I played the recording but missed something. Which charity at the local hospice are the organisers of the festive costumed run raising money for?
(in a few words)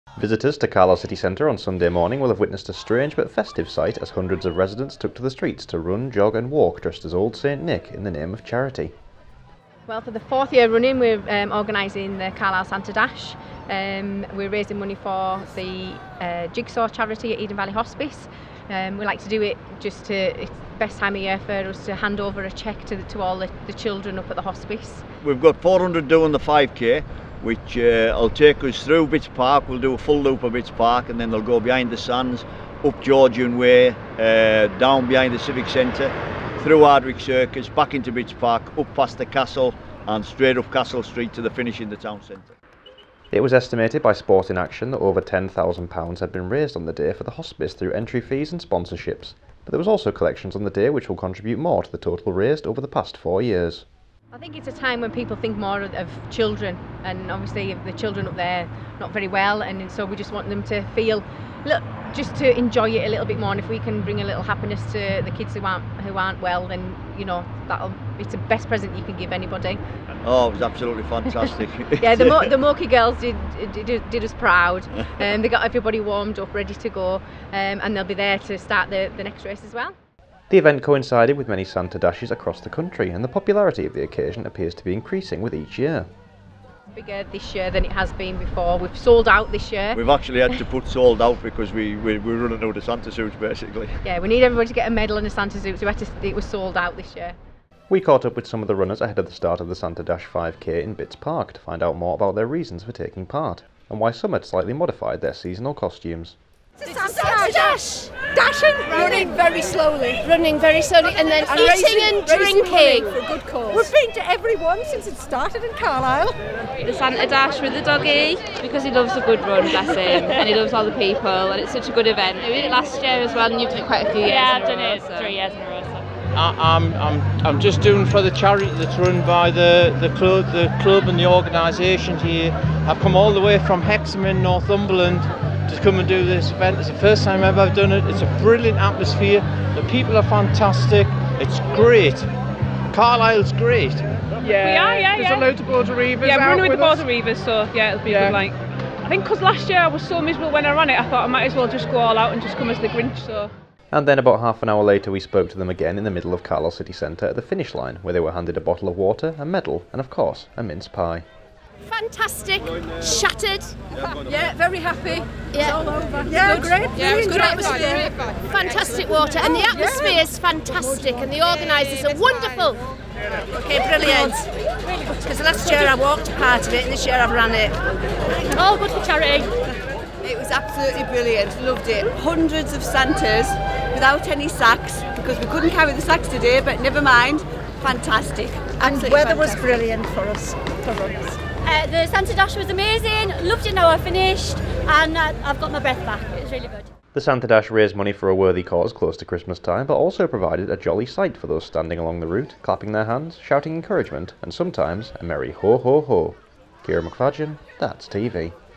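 Jigsaw.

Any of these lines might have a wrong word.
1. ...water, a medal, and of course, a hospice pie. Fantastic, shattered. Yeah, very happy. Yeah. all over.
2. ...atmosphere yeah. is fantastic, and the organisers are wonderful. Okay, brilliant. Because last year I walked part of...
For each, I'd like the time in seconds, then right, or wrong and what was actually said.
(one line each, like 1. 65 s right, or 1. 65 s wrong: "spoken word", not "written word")
1. 158 s wrong: "mince", not "hospice"
2. 169 s right.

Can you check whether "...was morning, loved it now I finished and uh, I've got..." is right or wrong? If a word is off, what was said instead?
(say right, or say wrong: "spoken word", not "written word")
wrong: "amazing", not "morning".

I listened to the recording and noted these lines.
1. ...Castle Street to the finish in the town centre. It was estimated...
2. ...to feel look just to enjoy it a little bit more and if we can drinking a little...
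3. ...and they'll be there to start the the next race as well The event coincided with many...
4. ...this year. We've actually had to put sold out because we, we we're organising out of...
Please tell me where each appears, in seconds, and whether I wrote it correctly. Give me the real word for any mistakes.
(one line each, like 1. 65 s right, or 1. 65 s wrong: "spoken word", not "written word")
1. 40 s right
2. 60 s wrong: "bring", not "drinking"
3. 77 s right
4. 89 s wrong: "running", not "organising".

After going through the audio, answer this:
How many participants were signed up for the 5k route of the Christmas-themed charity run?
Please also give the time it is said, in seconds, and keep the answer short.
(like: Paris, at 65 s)
400, at 25 s.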